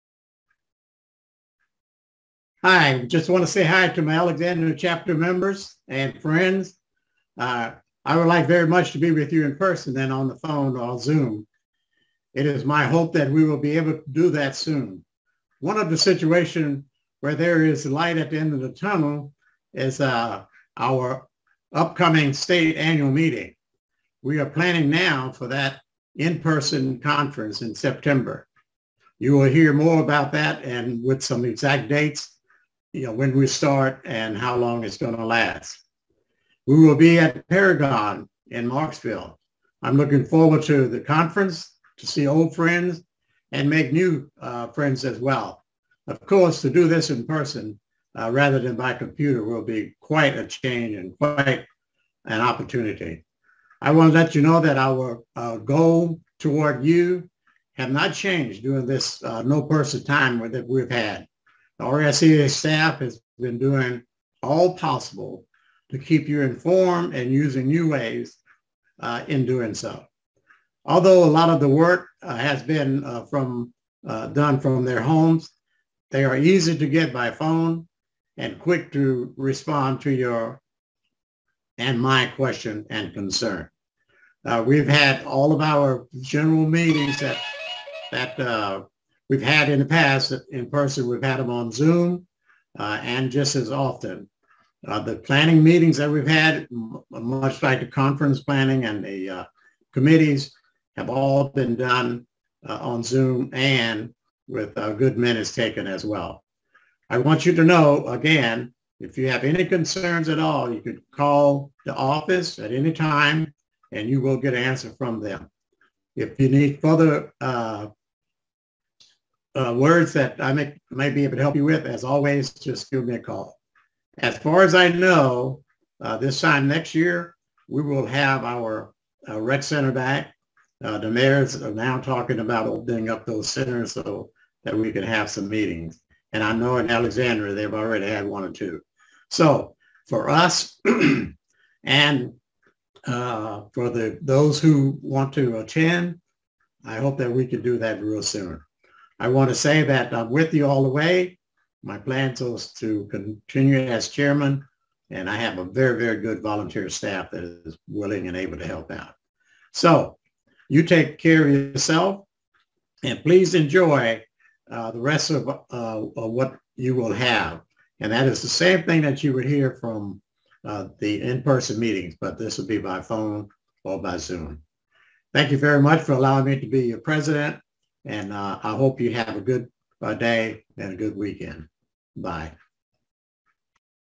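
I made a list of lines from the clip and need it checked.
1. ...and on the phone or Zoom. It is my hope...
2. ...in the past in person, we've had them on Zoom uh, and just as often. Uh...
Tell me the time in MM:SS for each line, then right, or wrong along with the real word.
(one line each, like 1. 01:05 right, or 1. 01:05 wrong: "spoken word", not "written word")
1. 00:09 right
2. 01:29 right.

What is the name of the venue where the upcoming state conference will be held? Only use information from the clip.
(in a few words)
Paragon.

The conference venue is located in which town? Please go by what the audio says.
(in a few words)
Marksville.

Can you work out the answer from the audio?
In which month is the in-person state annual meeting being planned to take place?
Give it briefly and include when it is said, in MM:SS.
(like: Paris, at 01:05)
September, at 00:27.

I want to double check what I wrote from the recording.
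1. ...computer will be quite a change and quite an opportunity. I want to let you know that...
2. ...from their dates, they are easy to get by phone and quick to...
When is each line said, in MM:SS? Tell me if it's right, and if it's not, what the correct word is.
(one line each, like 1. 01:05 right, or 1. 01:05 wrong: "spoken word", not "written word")
1. 00:48 right
2. 01:14 wrong: "homes", not "dates".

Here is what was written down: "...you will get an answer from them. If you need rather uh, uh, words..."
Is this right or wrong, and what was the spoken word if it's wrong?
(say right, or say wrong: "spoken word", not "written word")
wrong: "further", not "rather".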